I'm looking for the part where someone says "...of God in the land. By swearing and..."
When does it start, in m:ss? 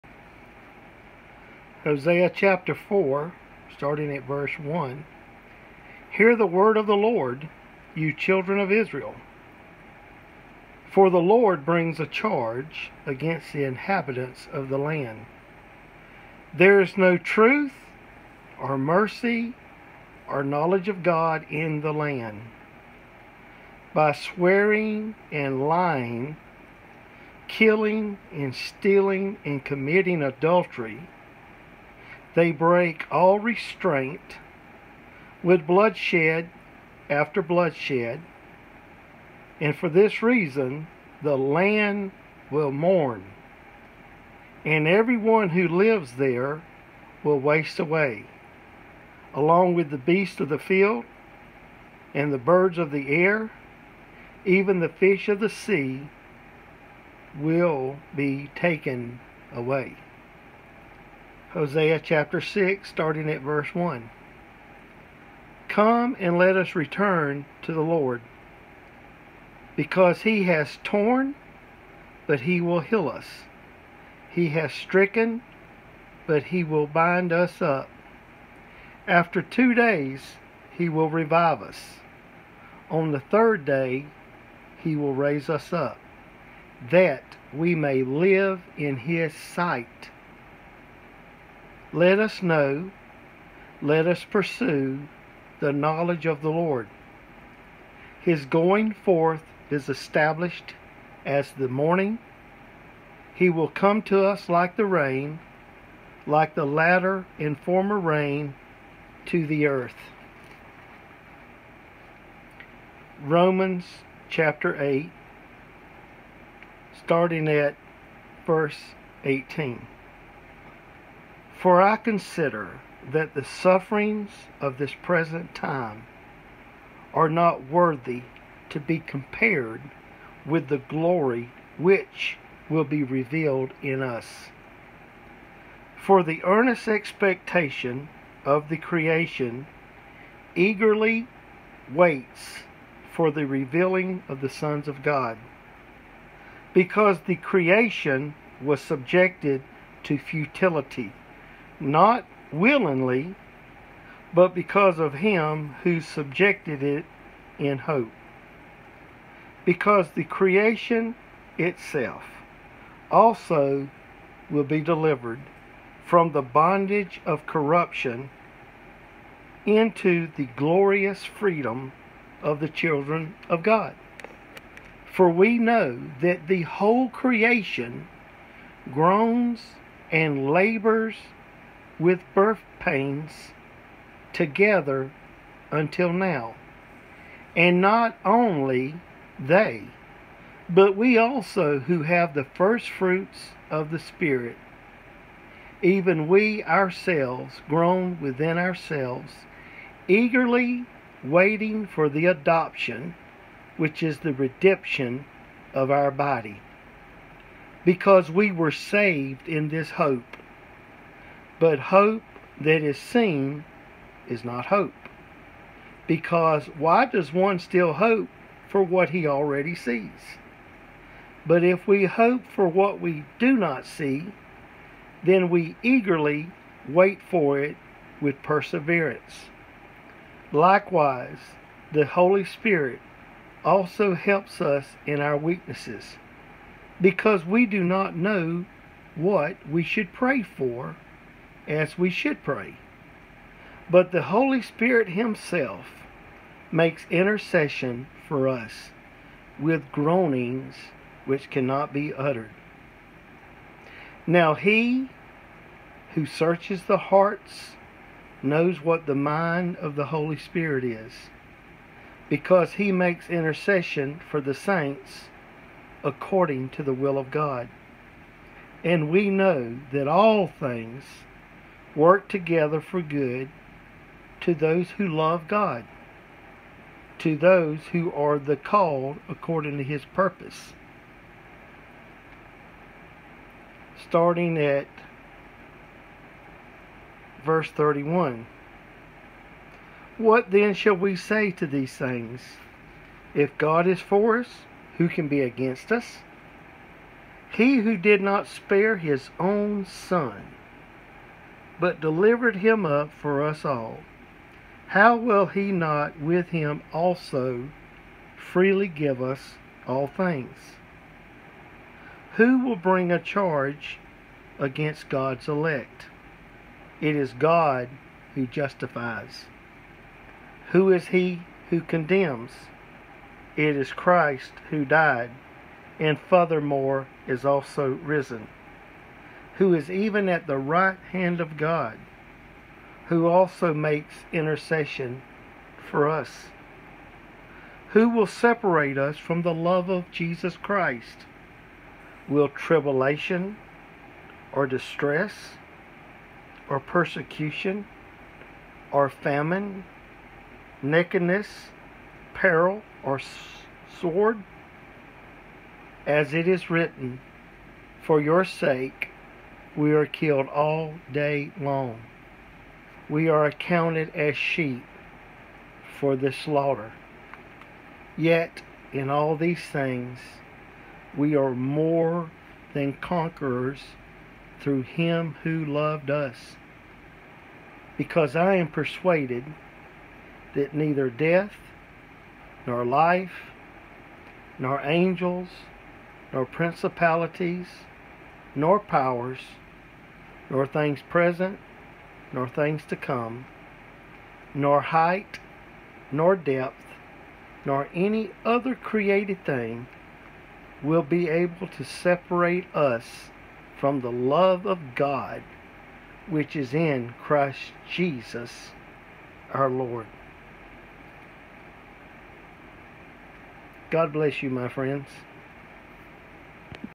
0:20.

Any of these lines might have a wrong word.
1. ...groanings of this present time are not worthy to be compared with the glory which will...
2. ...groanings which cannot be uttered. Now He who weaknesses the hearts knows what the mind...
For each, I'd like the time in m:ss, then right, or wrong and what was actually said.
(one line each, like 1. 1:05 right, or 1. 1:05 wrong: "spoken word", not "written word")
1. 2:03 wrong: "sufferings", not "groanings"
2. 4:09 wrong: "searches", not "weaknesses".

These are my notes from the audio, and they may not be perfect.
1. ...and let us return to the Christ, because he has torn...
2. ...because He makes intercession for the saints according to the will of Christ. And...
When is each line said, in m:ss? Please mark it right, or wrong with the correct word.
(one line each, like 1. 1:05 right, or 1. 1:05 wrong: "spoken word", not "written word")
1. 1:06 wrong: "Lord", not "Christ"
2. 4:22 wrong: "God", not "Christ".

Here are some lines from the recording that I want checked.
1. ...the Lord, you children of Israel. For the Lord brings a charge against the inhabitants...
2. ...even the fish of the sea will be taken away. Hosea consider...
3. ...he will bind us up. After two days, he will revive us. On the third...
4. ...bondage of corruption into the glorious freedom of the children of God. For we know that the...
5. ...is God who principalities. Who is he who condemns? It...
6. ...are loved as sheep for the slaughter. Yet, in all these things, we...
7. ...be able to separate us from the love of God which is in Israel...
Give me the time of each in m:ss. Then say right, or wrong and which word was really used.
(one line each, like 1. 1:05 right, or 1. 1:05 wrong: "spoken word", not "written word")
1. 0:06 right
2. 0:54 wrong: "chapter", not "consider"
3. 1:16 right
4. 2:46 right
5. 5:17 wrong: "justifies", not "principalities"
6. 6:03 wrong: "accounted", not "loved"
7. 6:41 wrong: "Christ", not "Israel".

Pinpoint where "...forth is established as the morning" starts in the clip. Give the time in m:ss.
1:38.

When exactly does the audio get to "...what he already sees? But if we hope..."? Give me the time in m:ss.
3:38.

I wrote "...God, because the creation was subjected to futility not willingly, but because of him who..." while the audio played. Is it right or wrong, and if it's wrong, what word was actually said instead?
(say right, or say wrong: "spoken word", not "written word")
right.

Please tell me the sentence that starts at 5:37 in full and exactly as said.
Who will separate us from the love of Jesus Christ?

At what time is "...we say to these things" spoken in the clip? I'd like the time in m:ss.
4:50.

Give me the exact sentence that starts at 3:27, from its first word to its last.
Because we were saved in this hope.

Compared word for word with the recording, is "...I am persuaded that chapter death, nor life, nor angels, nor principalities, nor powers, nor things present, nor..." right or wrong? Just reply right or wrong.
wrong.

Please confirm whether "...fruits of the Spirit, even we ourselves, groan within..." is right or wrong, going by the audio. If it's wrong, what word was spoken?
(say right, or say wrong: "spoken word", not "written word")
right.